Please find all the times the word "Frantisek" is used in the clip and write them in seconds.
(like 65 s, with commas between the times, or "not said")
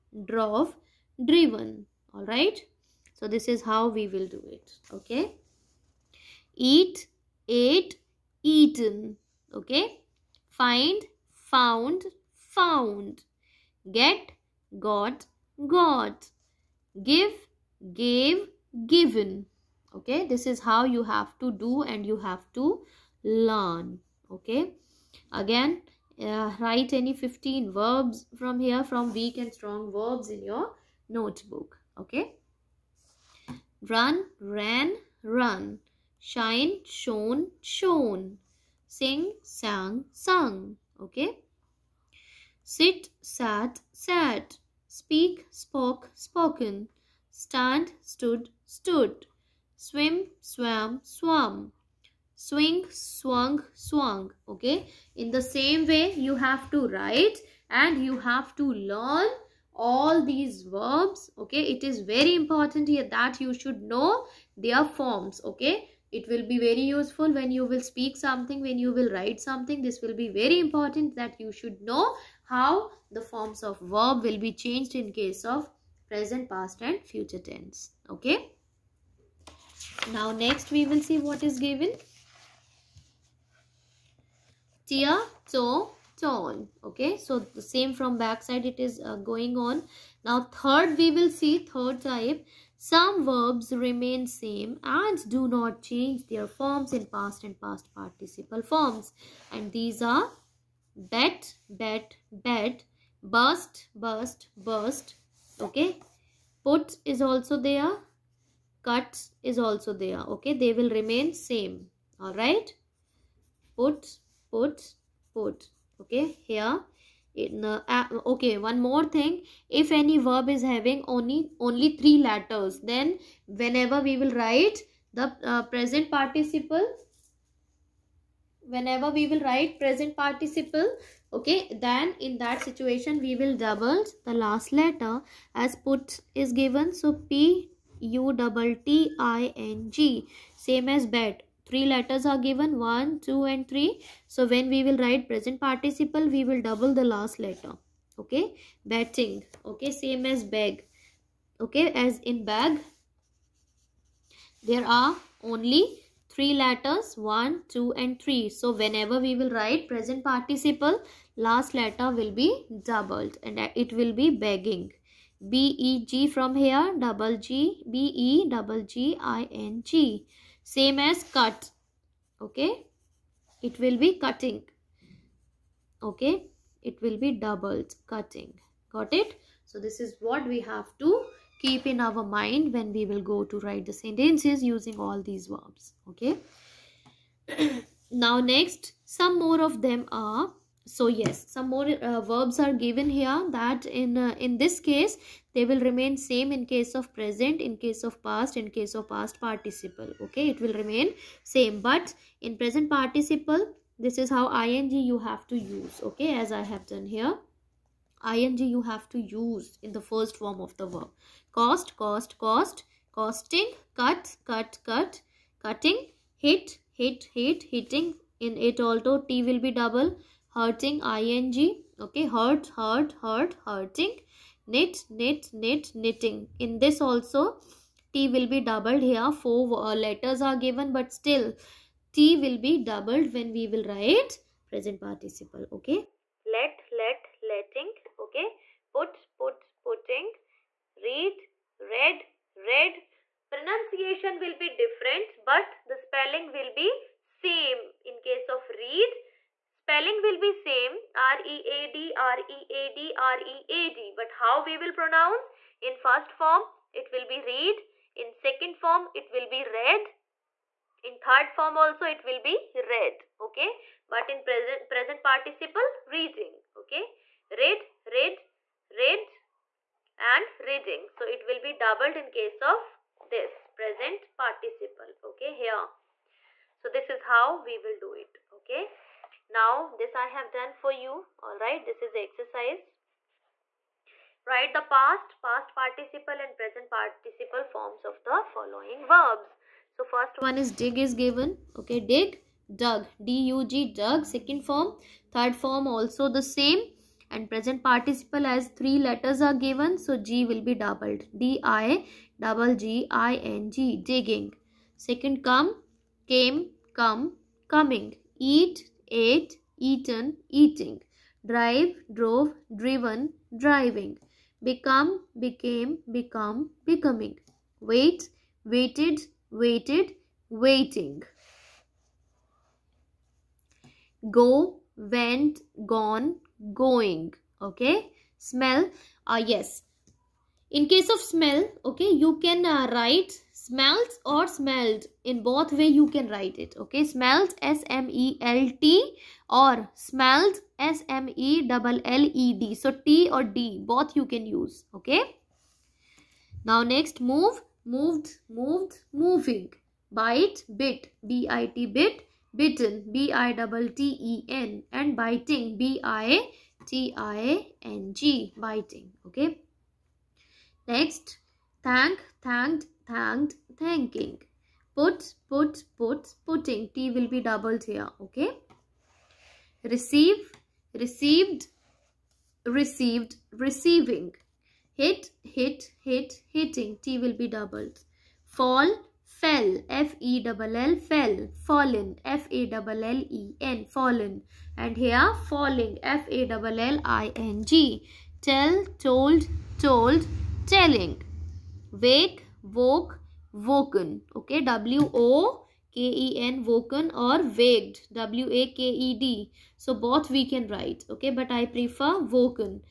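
not said.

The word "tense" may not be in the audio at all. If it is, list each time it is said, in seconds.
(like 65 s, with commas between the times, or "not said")
77 s.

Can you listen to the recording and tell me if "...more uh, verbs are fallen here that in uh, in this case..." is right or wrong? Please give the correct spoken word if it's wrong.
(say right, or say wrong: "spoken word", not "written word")
wrong: "given", not "fallen".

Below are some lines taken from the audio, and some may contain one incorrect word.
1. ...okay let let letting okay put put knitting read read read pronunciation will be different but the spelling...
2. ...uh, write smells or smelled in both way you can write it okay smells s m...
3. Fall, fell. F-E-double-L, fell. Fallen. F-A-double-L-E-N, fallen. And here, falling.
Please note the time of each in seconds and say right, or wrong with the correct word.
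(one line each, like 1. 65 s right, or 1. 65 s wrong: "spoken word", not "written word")
1. 235 s wrong: "putting", not "knitting"
2. 332 s right
3. 378 s right.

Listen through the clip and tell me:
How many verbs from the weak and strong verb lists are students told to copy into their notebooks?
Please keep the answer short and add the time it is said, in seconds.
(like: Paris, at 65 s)
15, at 27 s.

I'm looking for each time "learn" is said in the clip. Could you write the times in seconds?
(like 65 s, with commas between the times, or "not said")
23 s, 58 s.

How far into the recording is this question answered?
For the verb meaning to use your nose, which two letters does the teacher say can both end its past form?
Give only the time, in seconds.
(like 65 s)
343 s.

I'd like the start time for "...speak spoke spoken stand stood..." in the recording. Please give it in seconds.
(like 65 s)
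44 s.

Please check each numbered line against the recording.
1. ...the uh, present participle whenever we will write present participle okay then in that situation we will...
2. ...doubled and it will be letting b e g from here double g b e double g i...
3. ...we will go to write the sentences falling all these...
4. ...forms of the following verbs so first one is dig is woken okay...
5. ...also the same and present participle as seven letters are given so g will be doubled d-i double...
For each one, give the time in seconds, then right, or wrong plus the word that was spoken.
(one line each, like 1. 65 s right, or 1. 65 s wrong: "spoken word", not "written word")
1. 125 s right
2. 162 s wrong: "begging", not "letting"
3. 182 s wrong: "using", not "falling"
4. 287 s wrong: "given", not "woken"
5. 295 s wrong: "three", not "seven".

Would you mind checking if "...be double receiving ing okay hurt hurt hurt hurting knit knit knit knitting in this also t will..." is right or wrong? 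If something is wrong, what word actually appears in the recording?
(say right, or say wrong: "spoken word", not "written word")
wrong: "hurting", not "receiving".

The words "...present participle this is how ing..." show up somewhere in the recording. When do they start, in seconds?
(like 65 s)
202 s.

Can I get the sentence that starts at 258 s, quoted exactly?
In second form, it will be read.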